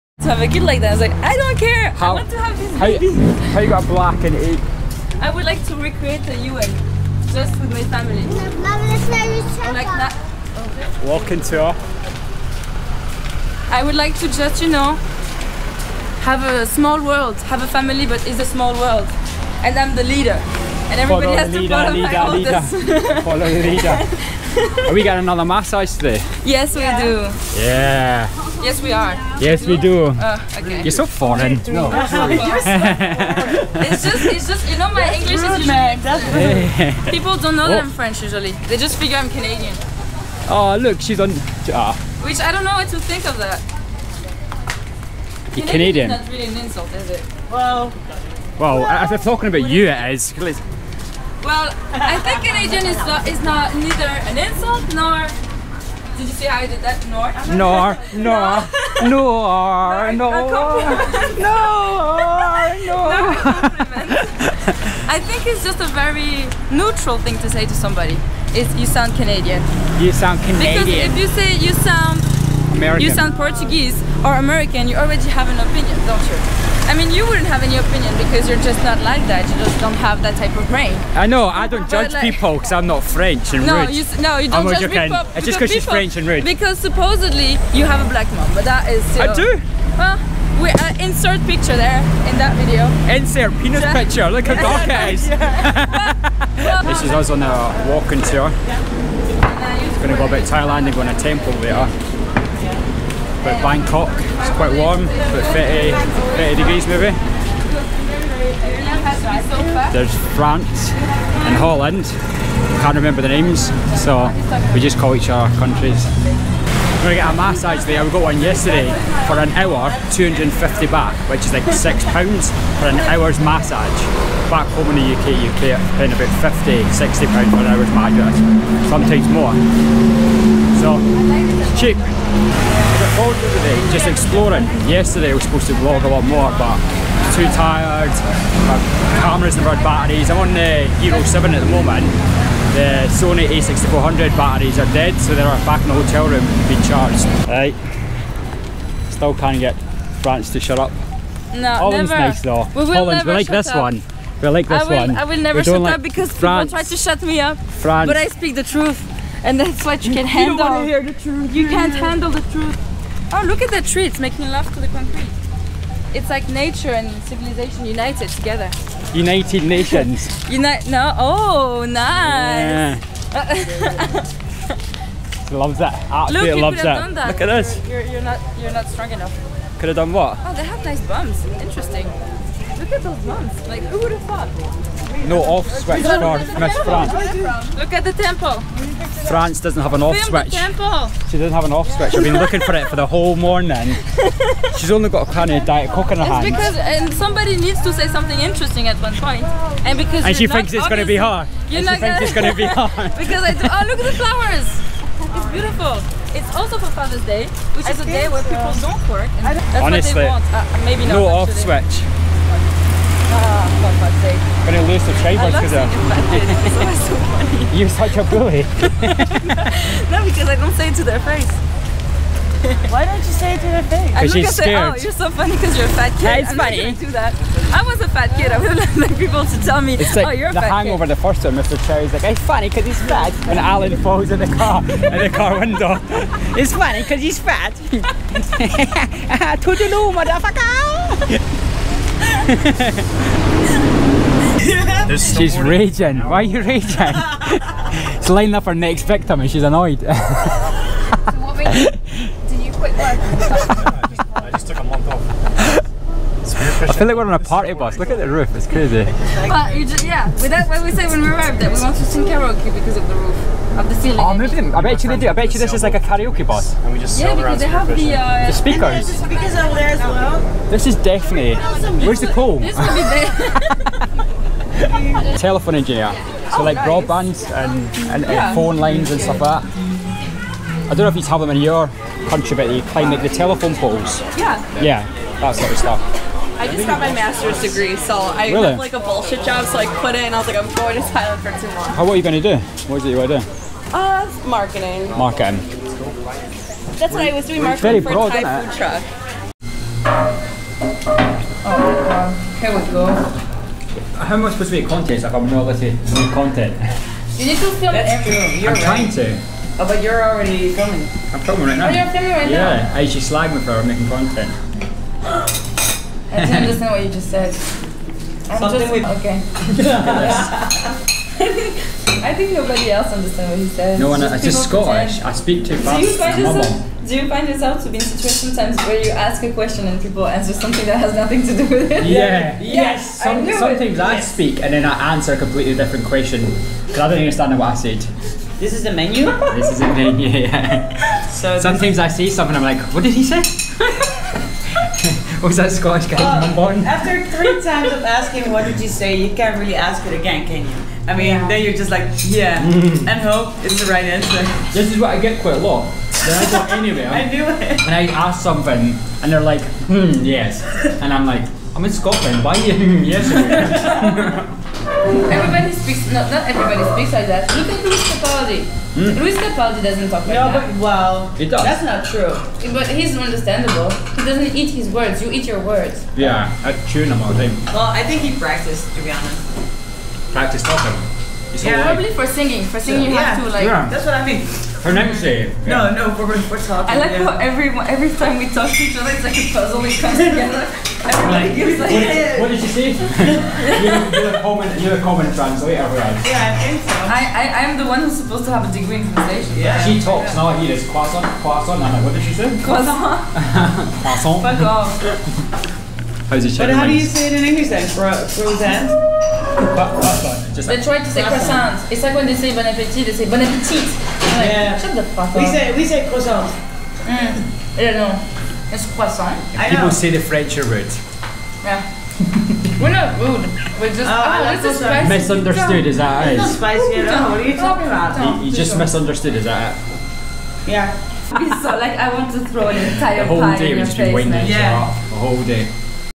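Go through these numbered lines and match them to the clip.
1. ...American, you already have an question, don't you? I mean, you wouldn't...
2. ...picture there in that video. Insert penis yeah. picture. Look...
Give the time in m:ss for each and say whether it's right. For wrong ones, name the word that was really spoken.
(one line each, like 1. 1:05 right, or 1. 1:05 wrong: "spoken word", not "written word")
1. 1:14 wrong: "opinion", not "question"
2. 1:31 right.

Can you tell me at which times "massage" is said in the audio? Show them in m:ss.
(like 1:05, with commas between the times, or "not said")
0:25, 1:57, 2:03, 2:07.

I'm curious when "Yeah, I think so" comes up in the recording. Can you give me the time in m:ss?
6:36.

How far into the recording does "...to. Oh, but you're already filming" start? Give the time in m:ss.
5:09.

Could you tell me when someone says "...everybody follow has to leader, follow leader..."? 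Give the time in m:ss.
0:20.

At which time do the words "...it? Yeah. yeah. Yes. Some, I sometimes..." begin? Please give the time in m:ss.
5:31.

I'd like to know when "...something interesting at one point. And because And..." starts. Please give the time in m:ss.
3:18.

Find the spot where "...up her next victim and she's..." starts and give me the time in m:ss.
4:08.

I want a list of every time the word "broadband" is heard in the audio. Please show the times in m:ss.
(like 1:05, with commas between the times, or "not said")
4:36.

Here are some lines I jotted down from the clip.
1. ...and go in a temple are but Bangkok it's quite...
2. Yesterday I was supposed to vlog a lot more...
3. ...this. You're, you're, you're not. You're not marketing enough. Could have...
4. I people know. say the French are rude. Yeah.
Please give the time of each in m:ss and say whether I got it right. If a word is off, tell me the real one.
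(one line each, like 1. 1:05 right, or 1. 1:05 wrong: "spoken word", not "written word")
1. 1:40 right
2. 2:14 right
3. 2:57 wrong: "strong", not "marketing"
4. 6:59 right.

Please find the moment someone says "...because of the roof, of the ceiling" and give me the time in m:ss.
4:22.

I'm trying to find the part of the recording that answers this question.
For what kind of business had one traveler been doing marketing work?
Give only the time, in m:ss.
4:58.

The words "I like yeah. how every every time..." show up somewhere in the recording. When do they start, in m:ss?
6:26.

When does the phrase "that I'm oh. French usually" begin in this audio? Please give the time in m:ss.
0:37.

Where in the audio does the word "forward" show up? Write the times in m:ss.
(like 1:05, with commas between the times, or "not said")
2:13.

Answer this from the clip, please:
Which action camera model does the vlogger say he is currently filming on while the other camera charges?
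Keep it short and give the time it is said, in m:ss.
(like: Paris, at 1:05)
Hero 7, at 2:20.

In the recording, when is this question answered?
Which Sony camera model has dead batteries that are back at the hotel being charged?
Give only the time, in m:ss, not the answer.
2:23.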